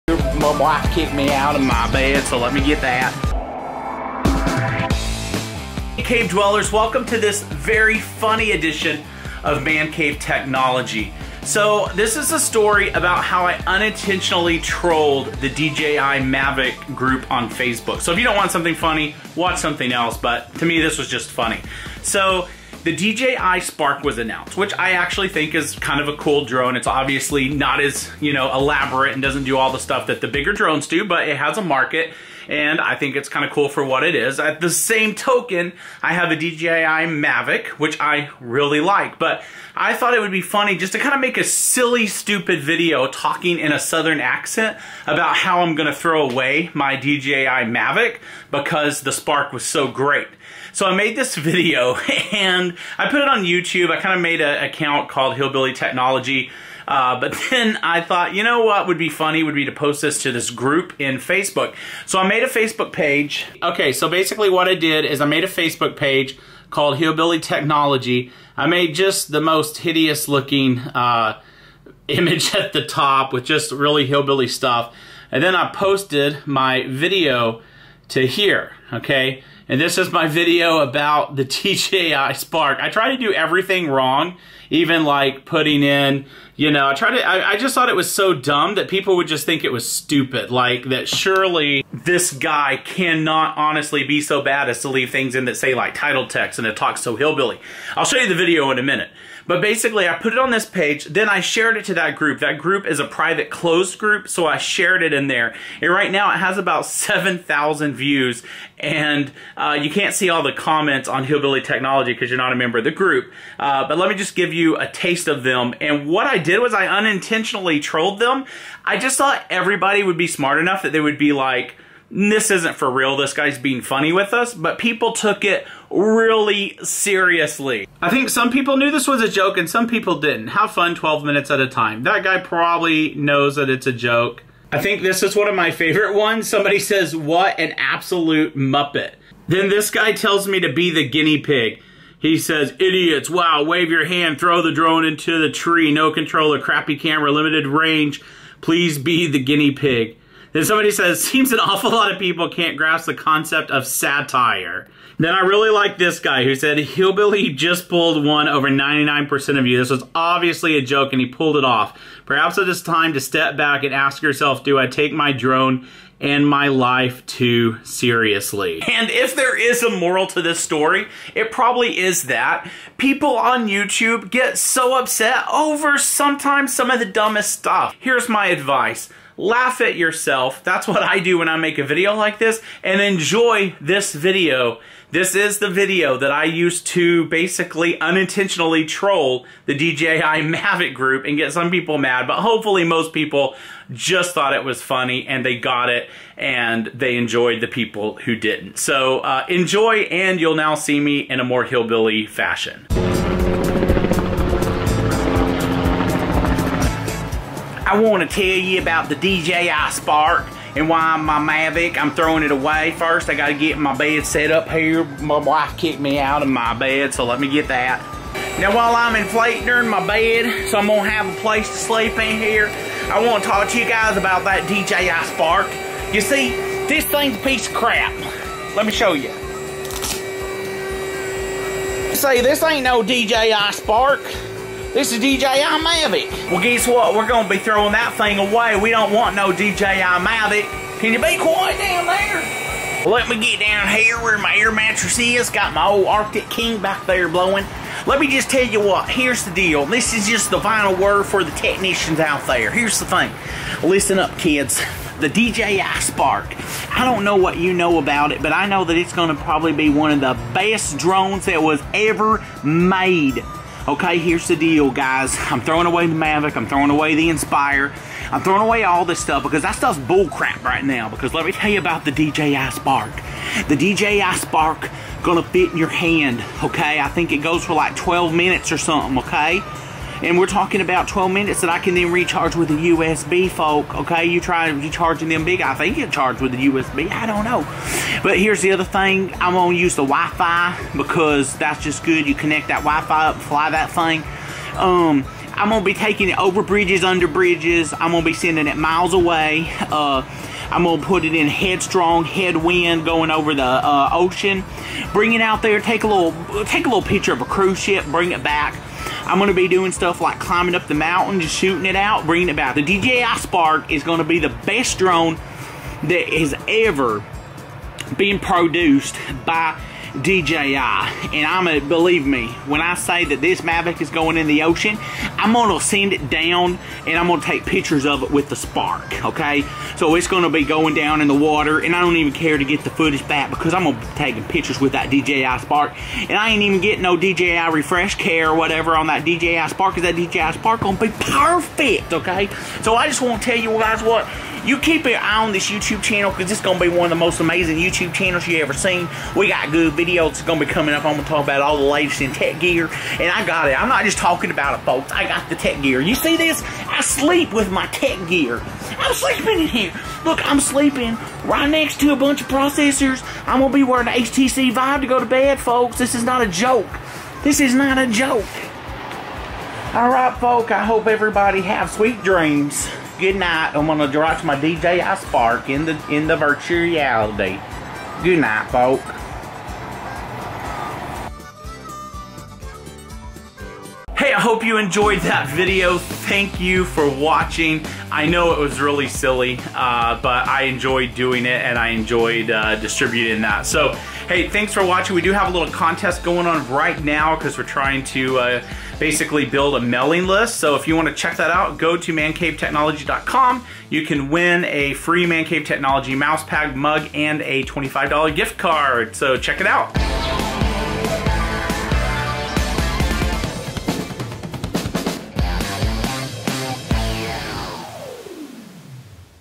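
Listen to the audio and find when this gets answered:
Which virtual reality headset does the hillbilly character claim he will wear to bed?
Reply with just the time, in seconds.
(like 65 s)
364 s.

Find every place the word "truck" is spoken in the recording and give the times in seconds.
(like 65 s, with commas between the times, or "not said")
not said.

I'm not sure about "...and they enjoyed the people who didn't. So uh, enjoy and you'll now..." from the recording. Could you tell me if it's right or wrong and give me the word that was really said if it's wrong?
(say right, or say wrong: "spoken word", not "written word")
right.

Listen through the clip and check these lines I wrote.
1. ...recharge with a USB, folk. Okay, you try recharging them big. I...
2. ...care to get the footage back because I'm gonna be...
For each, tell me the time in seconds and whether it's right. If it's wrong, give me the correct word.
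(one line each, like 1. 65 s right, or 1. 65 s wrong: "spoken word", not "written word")
1. 282 s right
2. 332 s right.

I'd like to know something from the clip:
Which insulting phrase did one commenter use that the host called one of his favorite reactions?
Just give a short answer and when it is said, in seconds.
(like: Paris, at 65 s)
what an absolute muppet, at 137 s.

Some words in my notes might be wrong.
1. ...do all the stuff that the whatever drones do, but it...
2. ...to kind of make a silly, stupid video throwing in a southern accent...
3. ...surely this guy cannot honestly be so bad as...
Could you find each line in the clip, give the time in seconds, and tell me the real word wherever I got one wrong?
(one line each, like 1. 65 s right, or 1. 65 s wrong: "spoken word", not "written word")
1. 29 s wrong: "bigger", not "whatever"
2. 40 s wrong: "talking", not "throwing"
3. 91 s right.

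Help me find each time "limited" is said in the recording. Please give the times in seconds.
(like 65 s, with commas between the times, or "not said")
147 s.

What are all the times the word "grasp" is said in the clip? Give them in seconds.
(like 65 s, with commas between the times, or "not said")
152 s.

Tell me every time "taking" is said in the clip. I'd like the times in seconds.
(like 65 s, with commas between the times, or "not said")
295 s, 334 s.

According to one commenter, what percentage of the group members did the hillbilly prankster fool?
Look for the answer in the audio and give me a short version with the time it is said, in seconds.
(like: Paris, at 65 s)
99%, at 158 s.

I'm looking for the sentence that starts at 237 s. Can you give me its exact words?
We're going to be throwing that thing away.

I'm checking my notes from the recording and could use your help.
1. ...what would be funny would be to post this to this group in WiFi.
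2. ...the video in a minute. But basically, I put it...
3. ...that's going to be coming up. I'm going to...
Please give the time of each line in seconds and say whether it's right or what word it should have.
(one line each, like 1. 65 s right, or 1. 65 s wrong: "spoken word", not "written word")
1. 58 s wrong: "Facebook", not "WiFi"
2. 98 s right
3. 350 s right.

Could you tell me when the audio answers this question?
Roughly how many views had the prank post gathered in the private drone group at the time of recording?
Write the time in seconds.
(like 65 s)
106 s.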